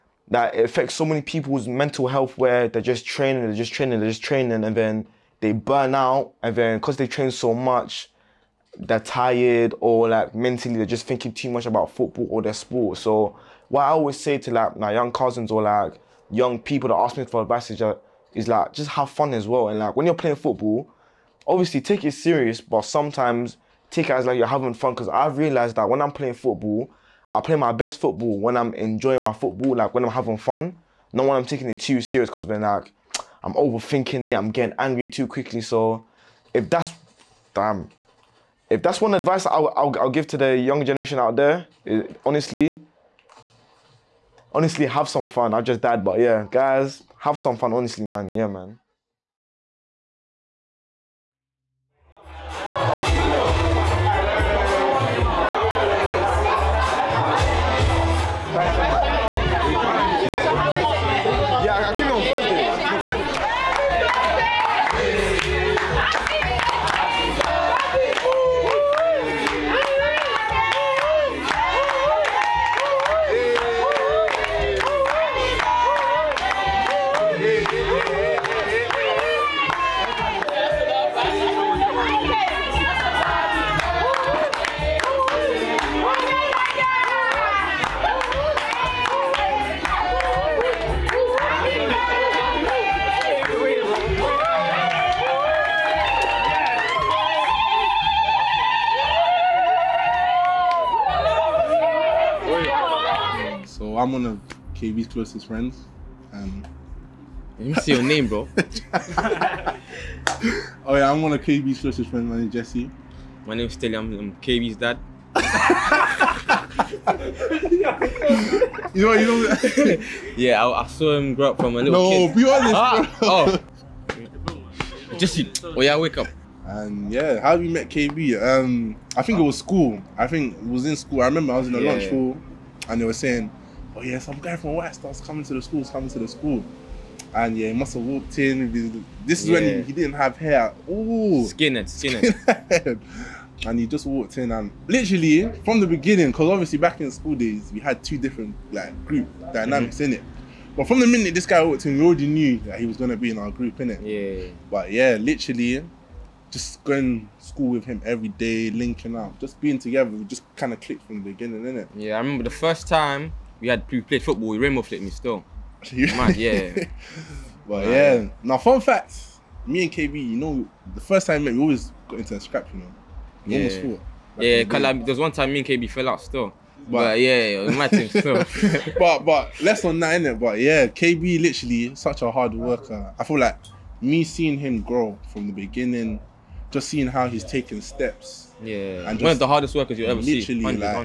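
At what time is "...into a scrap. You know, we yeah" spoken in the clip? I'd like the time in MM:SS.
02:52.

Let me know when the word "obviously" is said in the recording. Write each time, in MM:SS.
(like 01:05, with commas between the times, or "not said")
00:21, 02:26.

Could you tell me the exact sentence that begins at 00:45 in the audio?
I just died, but yeah, guys, have some fun.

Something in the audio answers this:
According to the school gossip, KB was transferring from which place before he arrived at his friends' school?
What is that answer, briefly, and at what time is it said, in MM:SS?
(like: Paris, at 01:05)
White Star, at 02:14.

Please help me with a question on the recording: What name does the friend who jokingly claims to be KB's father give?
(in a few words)
Telly.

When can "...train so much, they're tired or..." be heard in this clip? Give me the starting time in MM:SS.
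00:07.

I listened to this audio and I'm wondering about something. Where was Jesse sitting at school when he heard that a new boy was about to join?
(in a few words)
Lunch hall.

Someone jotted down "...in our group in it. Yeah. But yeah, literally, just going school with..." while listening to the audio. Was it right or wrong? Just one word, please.
right.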